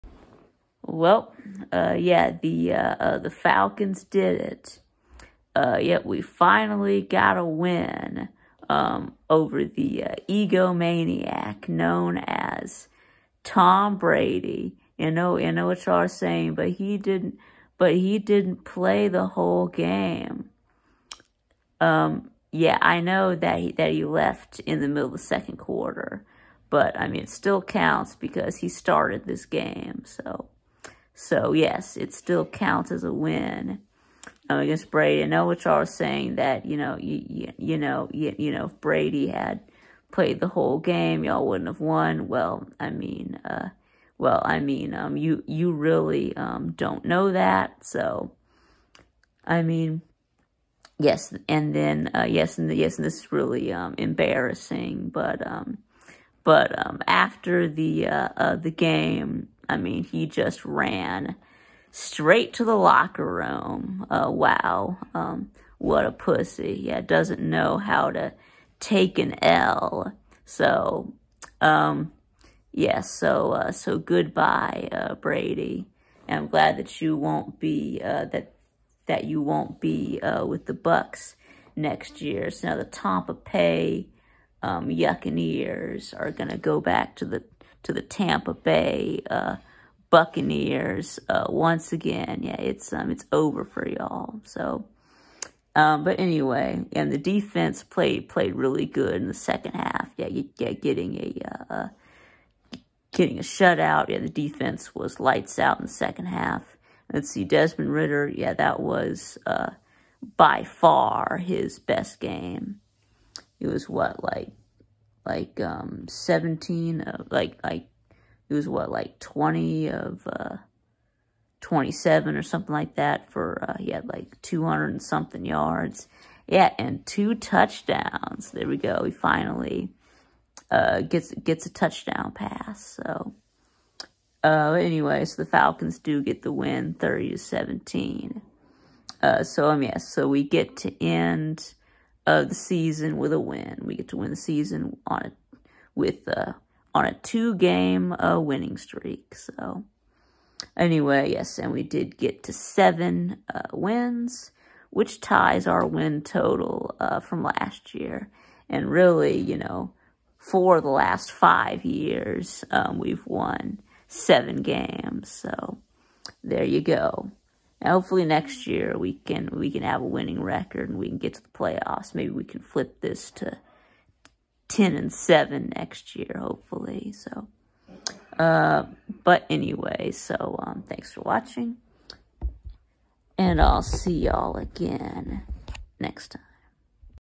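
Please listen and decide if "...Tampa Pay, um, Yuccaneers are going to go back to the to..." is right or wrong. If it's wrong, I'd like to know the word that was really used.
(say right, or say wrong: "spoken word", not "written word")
right.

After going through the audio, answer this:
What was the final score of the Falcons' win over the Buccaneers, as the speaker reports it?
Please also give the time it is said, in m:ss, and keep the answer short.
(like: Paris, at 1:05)
30 to 17, at 2:16.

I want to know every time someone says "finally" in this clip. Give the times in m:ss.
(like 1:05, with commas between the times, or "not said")
0:06, 2:09.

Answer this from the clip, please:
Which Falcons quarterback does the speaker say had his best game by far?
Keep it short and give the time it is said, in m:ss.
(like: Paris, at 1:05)
Desmond Ridder, at 1:47.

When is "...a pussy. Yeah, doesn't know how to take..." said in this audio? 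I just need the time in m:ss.
1:06.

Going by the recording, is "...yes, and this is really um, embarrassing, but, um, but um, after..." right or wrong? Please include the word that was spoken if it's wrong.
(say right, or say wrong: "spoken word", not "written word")
right.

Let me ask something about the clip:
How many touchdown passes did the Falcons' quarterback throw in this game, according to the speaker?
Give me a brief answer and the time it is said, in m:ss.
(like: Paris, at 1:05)
2, at 2:07.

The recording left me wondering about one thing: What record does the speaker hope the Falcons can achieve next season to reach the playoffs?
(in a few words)
10 and 7.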